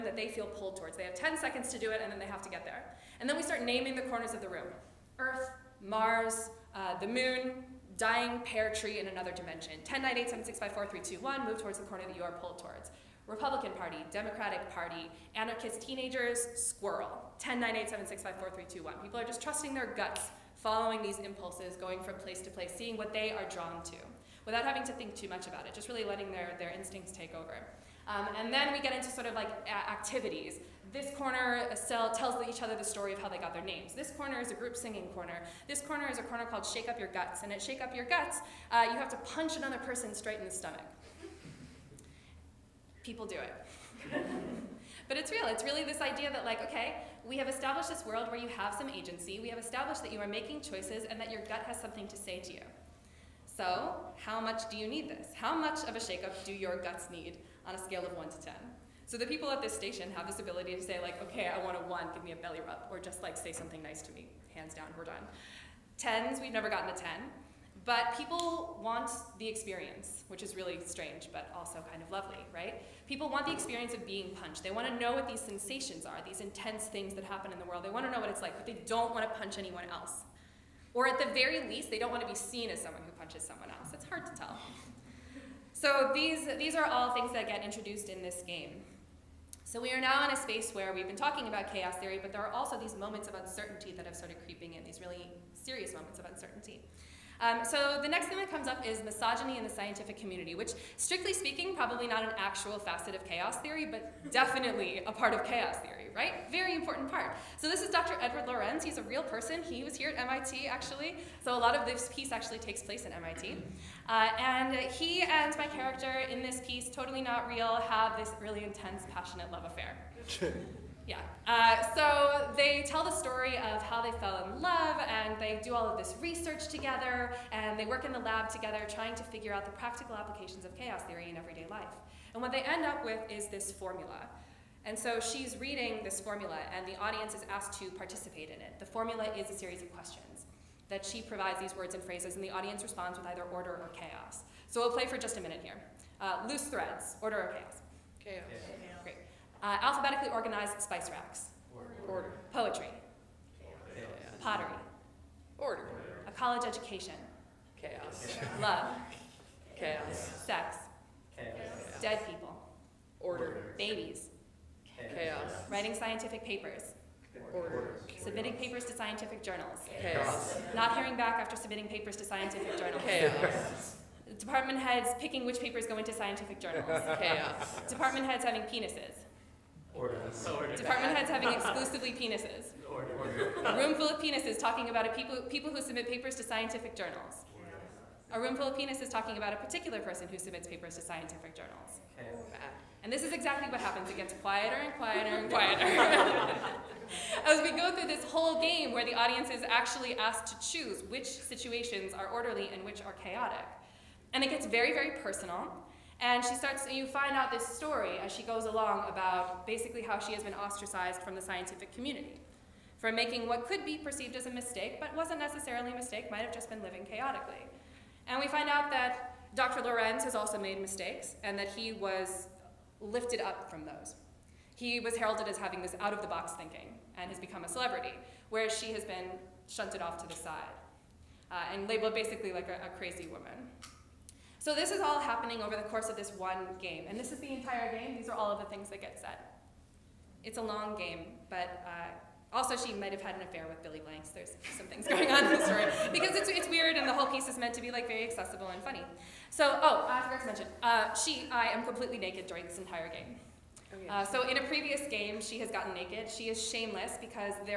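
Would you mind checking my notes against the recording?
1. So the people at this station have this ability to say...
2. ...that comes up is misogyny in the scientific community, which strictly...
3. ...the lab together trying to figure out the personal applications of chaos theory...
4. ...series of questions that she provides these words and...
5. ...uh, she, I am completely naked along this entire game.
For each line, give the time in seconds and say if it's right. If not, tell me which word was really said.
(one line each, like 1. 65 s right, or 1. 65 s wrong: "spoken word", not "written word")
1. 59 s right
2. 98 s right
3. 128 s wrong: "practical", not "personal"
4. 139 s right
5. 250 s wrong: "during", not "along".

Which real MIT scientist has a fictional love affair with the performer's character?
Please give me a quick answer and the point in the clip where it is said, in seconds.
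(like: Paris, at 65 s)
Edward Lorenz, at 107 s.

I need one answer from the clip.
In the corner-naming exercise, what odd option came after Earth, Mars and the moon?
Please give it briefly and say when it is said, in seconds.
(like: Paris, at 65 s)
Dying pear tree in another dimension, at 8 s.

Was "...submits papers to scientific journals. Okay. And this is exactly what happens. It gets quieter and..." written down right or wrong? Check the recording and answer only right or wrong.
right.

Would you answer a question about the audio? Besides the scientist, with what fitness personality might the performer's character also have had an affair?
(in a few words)
Billy Blanks.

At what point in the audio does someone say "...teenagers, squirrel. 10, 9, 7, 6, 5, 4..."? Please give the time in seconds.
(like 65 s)
15 s.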